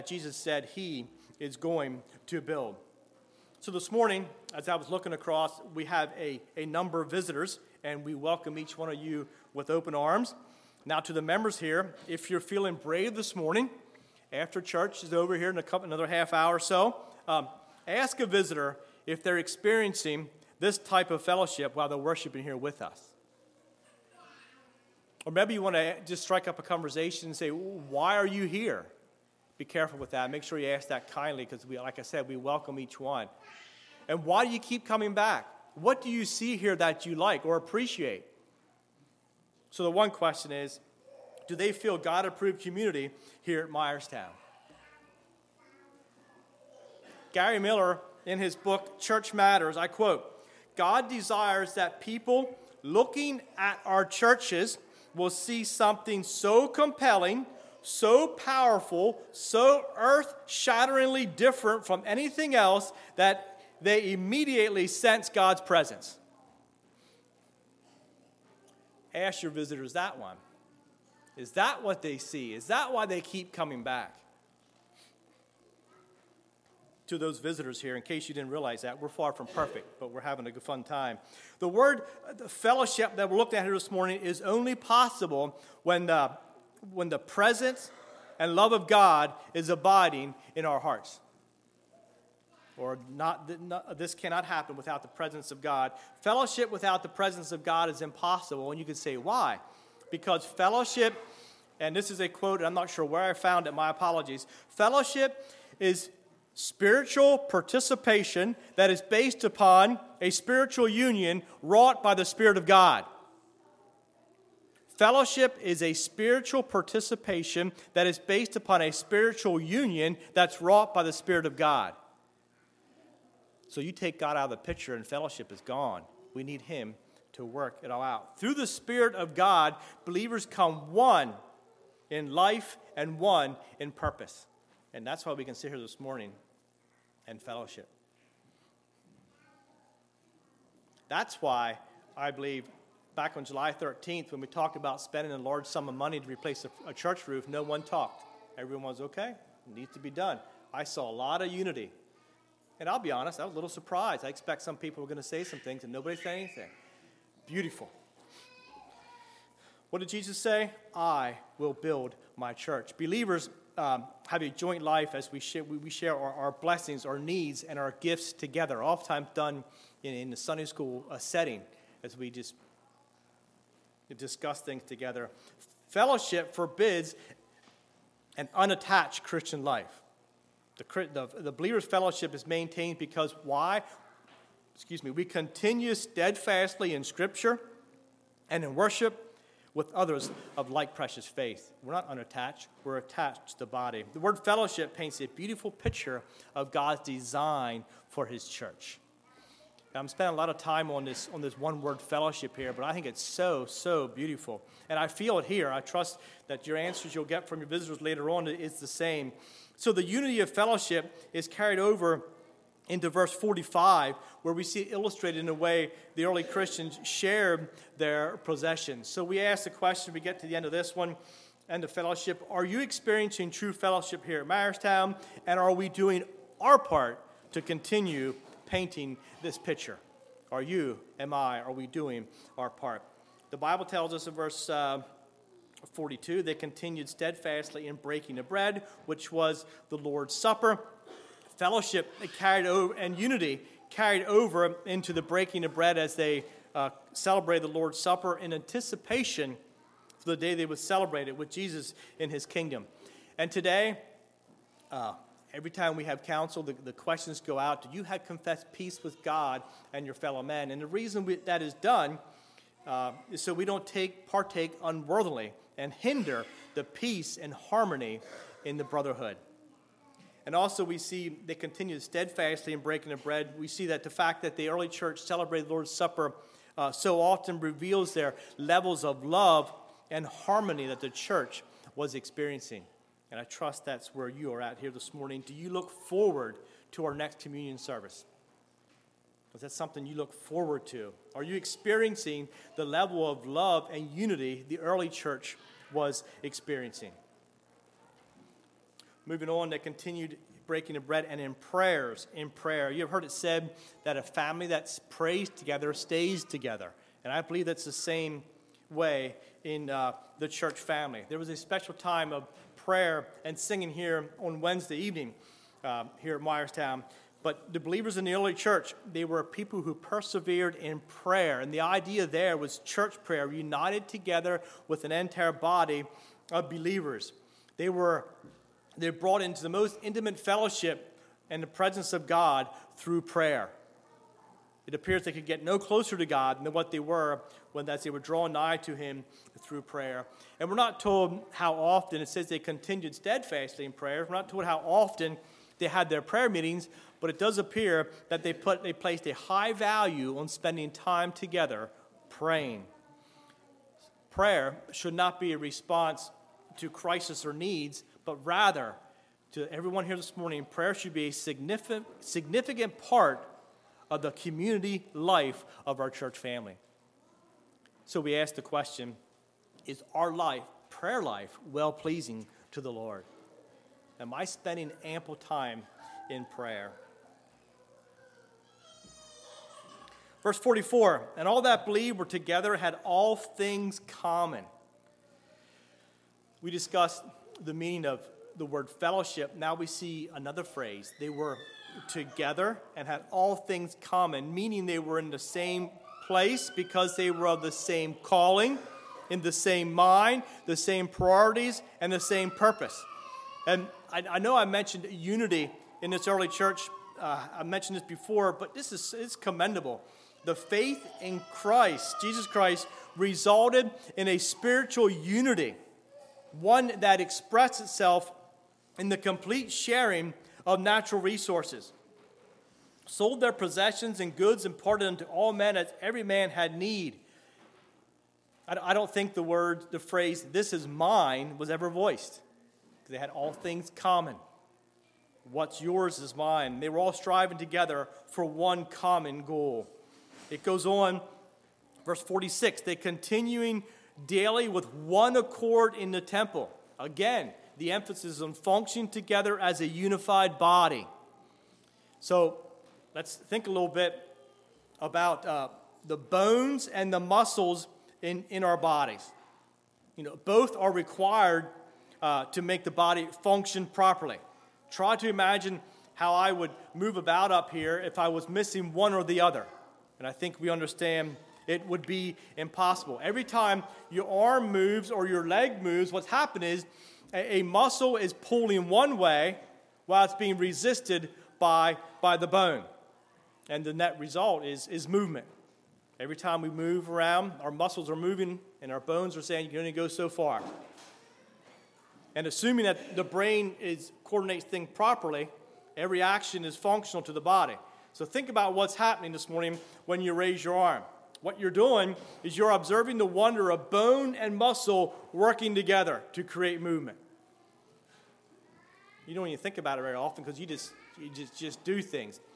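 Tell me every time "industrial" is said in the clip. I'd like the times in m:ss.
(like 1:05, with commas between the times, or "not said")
not said.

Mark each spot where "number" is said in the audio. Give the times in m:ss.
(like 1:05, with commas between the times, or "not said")
0:06.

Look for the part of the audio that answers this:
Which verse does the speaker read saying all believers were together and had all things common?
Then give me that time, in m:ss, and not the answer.
6:20.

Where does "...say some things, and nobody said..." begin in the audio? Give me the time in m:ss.
2:35.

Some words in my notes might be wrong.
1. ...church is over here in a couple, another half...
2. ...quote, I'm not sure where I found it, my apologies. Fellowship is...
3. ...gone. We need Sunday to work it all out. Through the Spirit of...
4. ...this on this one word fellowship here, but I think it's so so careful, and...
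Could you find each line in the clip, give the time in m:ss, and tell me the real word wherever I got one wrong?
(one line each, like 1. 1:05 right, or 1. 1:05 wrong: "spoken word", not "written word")
1. 0:14 right
2. 1:42 right
3. 2:05 wrong: "Him", not "Sunday"
4. 3:21 wrong: "beautiful", not "careful".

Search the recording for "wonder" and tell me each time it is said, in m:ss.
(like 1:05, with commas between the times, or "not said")
8:23.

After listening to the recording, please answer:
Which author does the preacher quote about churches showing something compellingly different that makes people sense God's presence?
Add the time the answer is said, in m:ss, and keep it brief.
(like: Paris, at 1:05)
Gary Miller, at 0:47.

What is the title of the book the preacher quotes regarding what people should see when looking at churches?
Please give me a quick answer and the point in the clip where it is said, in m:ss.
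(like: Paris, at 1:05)
Church Matters, at 0:48.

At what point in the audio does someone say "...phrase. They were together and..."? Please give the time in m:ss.
6:30.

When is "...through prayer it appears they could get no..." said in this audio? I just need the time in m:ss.
5:32.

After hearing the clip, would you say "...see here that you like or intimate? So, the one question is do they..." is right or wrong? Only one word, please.
wrong.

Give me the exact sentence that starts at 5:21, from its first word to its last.
And the idea there was church prayer, united together with an entire body of believers.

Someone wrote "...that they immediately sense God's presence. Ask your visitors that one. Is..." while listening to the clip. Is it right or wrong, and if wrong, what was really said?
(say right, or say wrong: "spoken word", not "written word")
right.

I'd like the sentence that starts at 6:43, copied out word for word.
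And I, I know I mentioned unity in this early church.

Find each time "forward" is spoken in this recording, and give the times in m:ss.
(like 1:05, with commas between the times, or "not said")
4:45, 4:50.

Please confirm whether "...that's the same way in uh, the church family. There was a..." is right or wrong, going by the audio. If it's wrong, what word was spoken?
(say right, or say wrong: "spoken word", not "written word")
right.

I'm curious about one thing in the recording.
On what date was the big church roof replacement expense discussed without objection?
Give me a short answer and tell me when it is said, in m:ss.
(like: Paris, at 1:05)
July 13th, at 2:23.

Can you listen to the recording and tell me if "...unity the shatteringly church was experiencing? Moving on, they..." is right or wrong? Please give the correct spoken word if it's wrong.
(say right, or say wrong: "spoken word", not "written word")
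wrong: "early", not "shatteringly".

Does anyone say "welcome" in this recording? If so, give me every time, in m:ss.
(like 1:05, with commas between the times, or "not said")
0:08, 0:32.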